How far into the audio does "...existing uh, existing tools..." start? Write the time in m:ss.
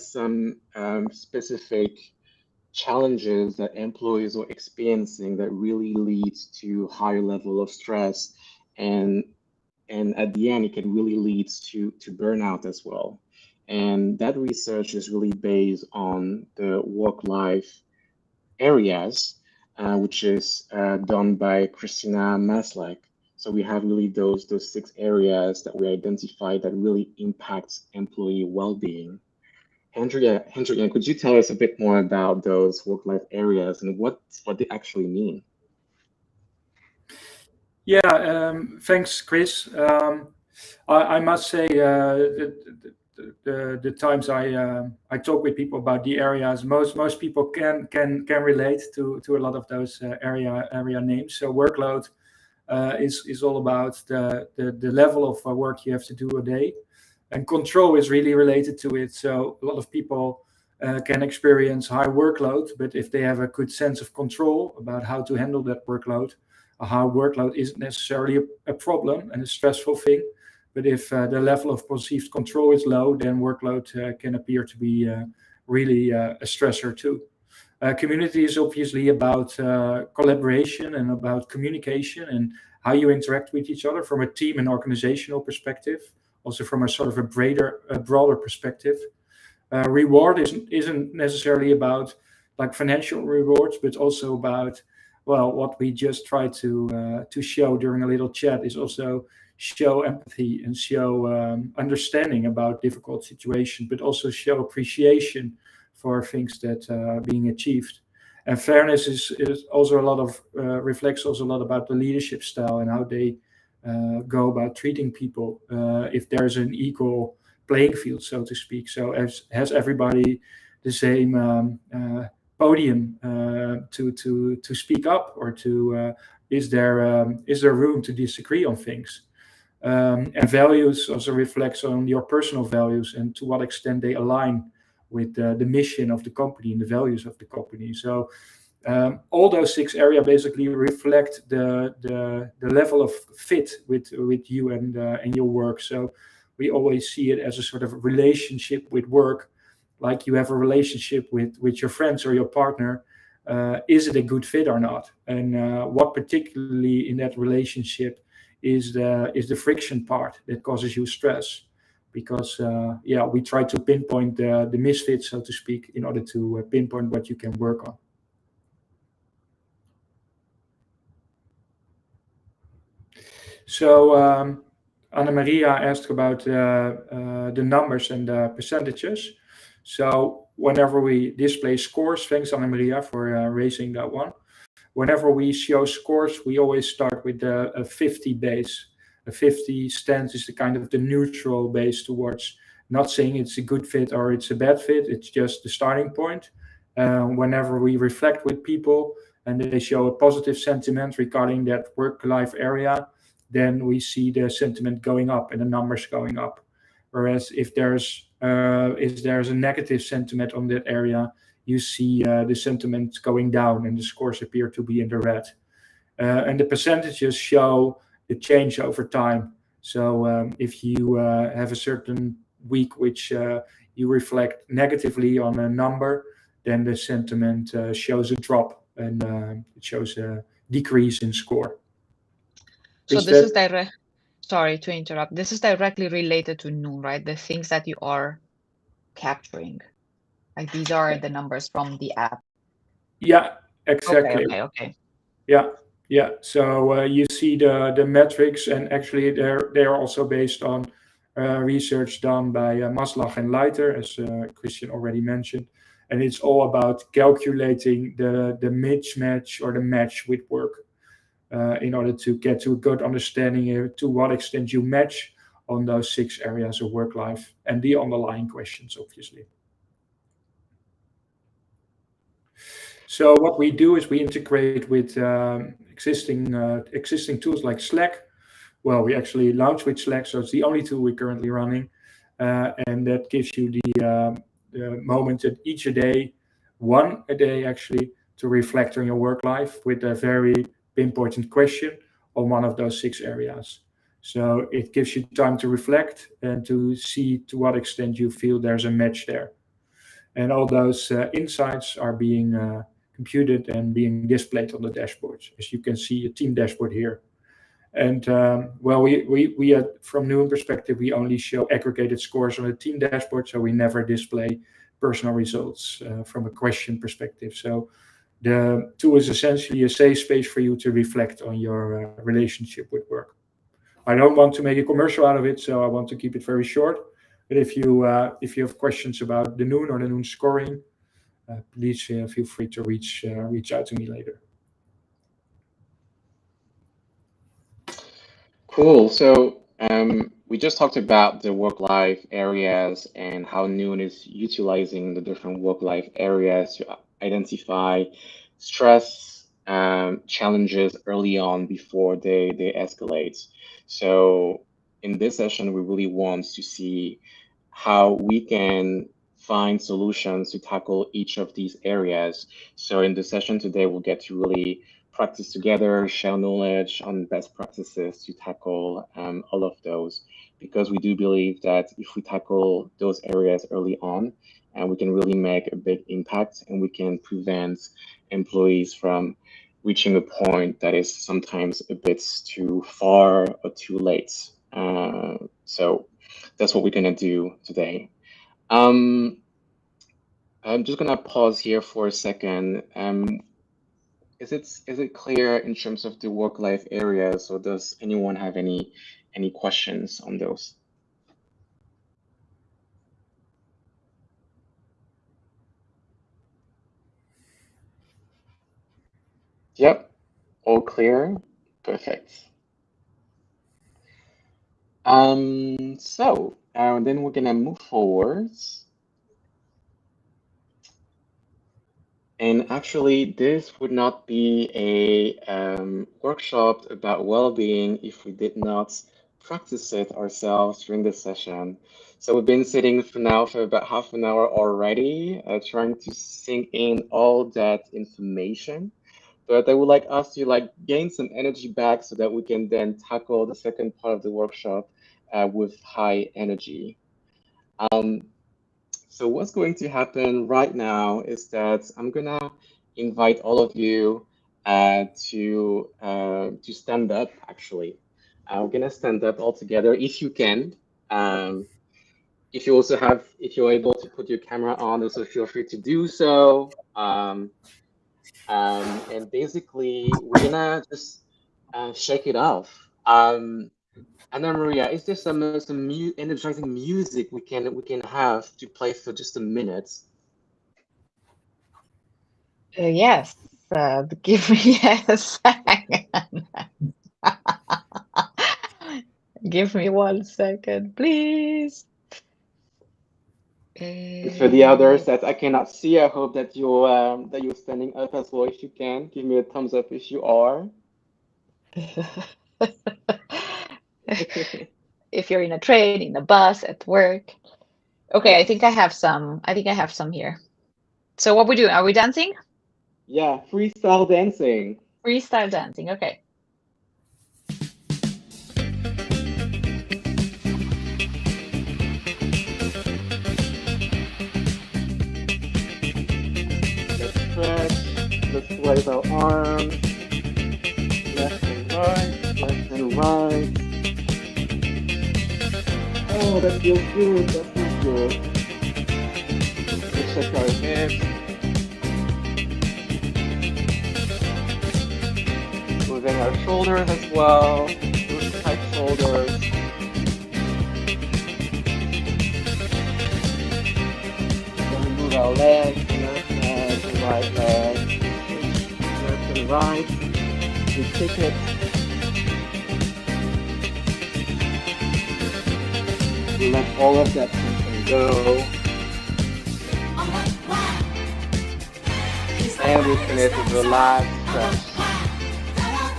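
4:35.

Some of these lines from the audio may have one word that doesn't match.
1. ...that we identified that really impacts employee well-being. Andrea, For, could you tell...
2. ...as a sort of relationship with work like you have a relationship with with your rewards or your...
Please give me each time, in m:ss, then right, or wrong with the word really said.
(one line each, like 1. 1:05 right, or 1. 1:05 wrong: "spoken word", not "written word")
1. 0:25 wrong: "Andrea", not "For"
2. 2:27 wrong: "friends", not "rewards".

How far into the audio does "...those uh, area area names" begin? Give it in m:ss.
0:49.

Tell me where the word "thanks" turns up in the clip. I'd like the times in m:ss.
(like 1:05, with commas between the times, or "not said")
0:38, 3:02.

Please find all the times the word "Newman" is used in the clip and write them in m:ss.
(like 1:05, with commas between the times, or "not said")
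5:10.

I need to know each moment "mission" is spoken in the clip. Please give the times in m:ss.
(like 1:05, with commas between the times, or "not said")
2:15.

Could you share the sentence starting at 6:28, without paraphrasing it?
Um, I'm just going to pause here for a second.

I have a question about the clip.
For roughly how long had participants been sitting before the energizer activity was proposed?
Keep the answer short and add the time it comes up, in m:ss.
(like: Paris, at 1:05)
Half an hour, at 7:13.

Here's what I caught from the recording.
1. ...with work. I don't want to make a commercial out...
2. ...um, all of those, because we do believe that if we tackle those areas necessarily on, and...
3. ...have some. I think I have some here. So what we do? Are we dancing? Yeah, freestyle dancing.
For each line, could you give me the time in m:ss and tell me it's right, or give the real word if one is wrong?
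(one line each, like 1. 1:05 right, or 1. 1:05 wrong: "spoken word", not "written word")
1. 5:22 right
2. 6:09 wrong: "early", not "necessarily"
3. 8:28 right.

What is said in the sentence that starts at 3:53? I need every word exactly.
So is this that, is direct sorry to interrupt.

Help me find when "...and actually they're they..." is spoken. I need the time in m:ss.
4:08.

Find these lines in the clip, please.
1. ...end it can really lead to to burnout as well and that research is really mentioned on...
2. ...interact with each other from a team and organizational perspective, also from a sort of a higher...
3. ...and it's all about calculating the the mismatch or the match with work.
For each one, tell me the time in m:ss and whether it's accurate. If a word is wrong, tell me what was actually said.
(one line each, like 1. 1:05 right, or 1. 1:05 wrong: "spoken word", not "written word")
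1. 0:10 wrong: "based", not "mentioned"
2. 1:23 wrong: "broader", not "higher"
3. 4:16 right.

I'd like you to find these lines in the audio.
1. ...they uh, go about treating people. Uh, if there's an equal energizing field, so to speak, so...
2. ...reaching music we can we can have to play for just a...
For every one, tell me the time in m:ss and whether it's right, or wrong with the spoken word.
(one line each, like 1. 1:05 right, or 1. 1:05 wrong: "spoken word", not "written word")
1. 1:53 wrong: "playing", not "energizing"
2. 7:56 wrong: "energizing", not "reaching".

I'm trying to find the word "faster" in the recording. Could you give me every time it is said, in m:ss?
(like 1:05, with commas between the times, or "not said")
not said.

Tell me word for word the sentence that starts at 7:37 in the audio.
Actually, uh, we're gonna stand up all together if you can.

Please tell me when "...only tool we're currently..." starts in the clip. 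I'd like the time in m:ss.
4:40.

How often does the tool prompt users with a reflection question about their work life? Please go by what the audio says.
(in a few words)
One a day.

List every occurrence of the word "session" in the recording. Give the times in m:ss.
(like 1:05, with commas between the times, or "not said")
5:55, 6:03, 7:11.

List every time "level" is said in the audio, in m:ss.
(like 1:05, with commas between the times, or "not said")
0:07, 0:54, 1:11, 2:22.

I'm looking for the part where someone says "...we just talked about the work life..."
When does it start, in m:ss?
5:40.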